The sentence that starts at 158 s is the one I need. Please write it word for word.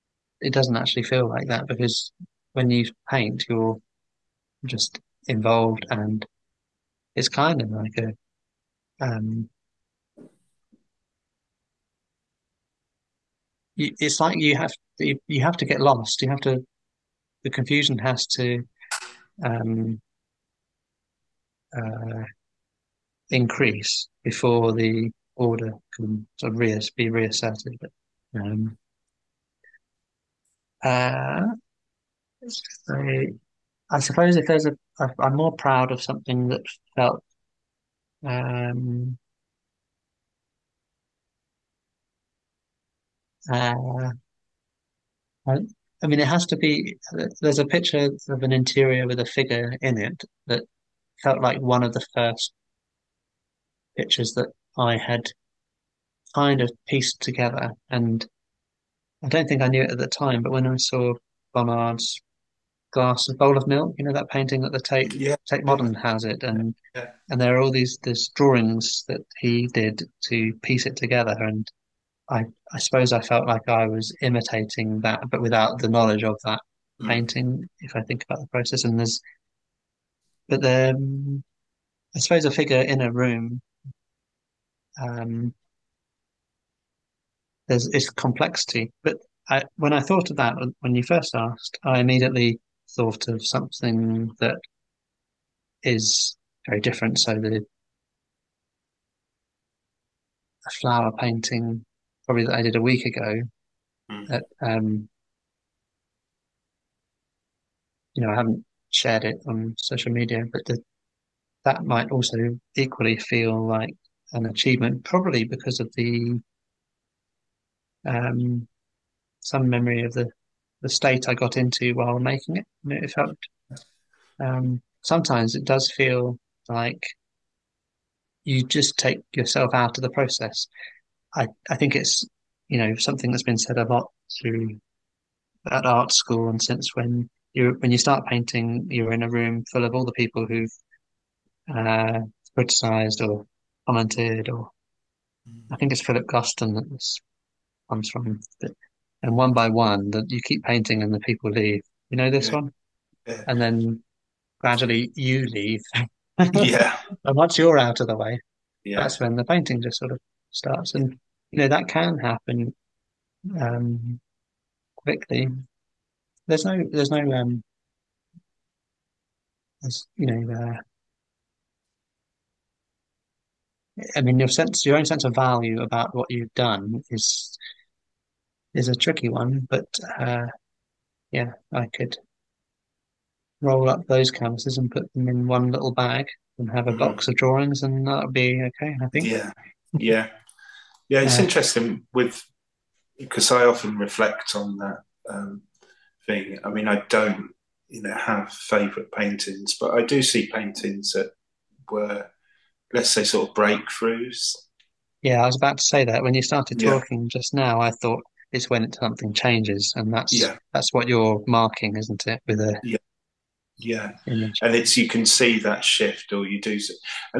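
that's when the painting just sort of starts.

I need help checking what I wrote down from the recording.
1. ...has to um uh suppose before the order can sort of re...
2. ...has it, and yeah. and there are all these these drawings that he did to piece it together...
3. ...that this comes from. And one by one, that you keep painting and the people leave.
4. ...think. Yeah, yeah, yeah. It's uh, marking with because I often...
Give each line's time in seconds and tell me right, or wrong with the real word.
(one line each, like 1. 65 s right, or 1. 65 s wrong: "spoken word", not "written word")
1. 17 s wrong: "increase", not "suppose"
2. 65 s right
3. 146 s right
4. 189 s wrong: "interesting", not "marking".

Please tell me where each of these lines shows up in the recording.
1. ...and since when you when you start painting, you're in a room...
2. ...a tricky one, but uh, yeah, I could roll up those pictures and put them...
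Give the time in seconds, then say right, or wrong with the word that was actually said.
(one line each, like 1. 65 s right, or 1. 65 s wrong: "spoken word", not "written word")
1. 136 s right
2. 178 s wrong: "canvases", not "pictures".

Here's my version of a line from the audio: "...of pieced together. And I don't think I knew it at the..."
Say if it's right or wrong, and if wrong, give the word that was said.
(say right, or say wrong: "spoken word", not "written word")
right.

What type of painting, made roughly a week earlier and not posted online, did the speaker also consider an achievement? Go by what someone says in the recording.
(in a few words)
A flower painting.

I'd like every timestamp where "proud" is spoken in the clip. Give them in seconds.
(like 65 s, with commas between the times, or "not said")
35 s.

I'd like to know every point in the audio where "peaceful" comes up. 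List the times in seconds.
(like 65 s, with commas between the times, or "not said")
not said.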